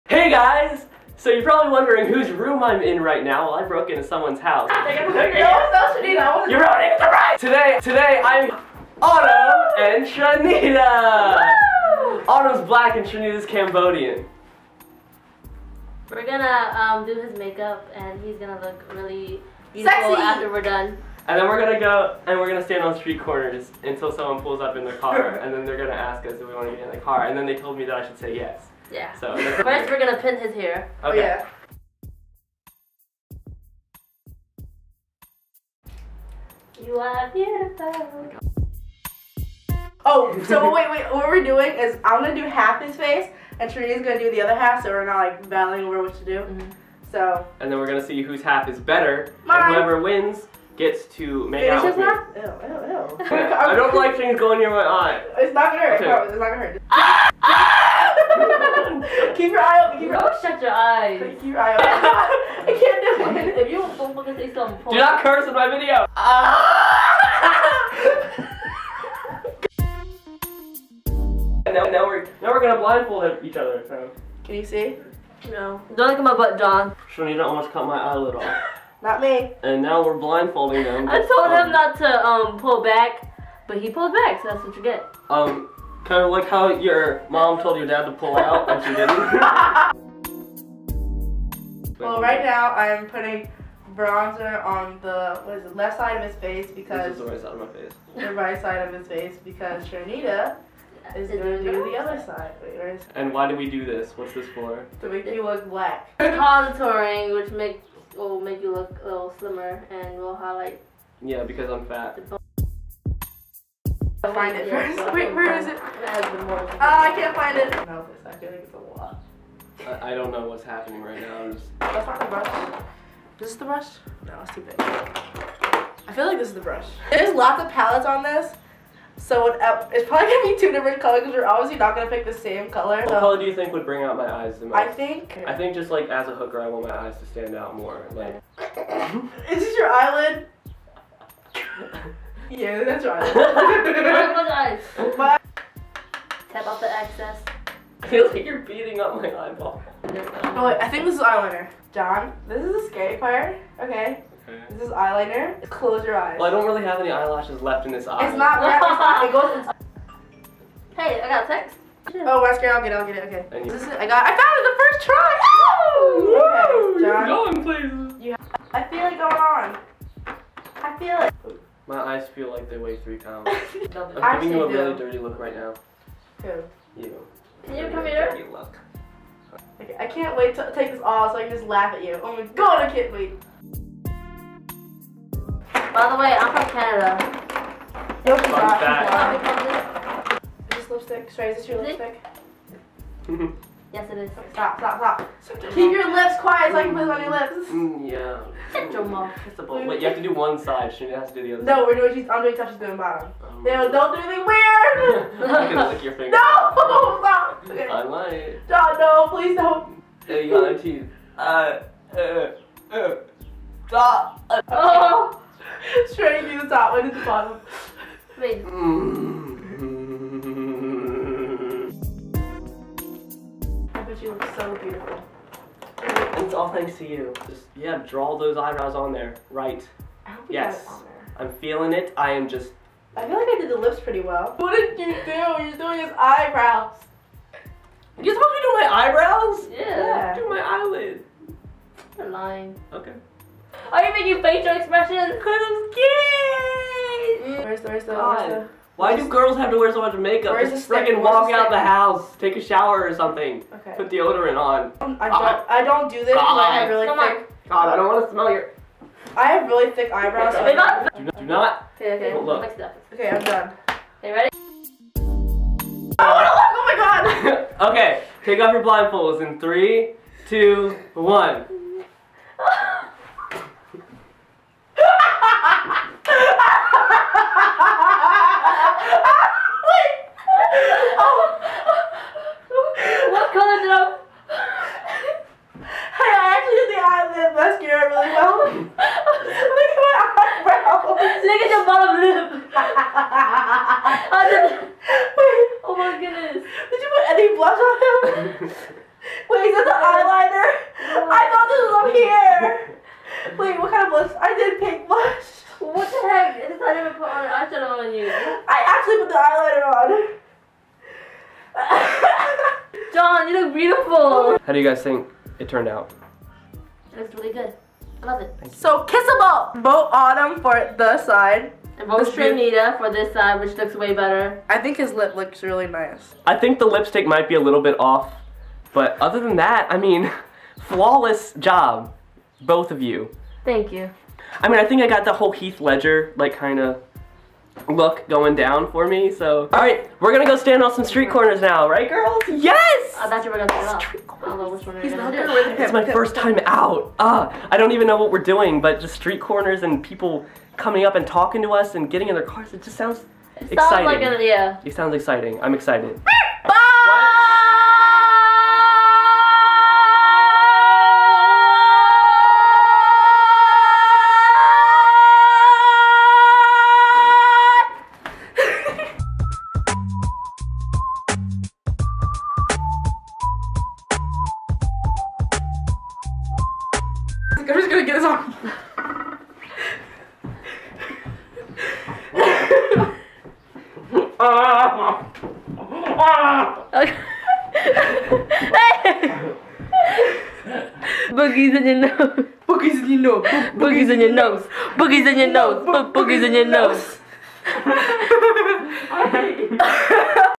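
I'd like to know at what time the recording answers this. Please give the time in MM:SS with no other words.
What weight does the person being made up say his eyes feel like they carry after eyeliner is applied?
02:52.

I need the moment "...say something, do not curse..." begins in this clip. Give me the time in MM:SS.
01:04.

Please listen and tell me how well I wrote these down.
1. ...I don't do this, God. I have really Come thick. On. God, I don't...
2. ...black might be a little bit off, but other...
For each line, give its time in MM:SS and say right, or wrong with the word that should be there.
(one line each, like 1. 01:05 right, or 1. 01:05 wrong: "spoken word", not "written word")
1. 04:15 right
2. 05:26 wrong: "lipstick", not "black".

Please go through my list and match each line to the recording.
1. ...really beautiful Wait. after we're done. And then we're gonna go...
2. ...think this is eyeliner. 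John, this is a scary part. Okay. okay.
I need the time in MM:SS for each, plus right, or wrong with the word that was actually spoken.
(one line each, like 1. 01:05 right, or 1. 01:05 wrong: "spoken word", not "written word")
1. 00:18 wrong: "Sexy", not "Wait"
2. 02:30 right.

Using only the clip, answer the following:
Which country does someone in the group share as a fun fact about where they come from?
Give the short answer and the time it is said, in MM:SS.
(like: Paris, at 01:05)
Canada, at 03:06.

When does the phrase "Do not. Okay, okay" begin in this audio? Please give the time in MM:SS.
04:21.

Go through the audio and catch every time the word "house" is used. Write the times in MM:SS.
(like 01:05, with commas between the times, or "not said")
00:04, 04:11.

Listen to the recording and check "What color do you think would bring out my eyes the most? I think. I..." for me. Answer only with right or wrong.
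right.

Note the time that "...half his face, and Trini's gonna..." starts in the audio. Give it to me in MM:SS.
00:42.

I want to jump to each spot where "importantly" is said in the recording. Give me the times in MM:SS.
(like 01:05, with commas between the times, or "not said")
not said.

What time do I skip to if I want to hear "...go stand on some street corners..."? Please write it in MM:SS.
05:40.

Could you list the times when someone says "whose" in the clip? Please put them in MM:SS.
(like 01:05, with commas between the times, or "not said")
00:02, 00:48.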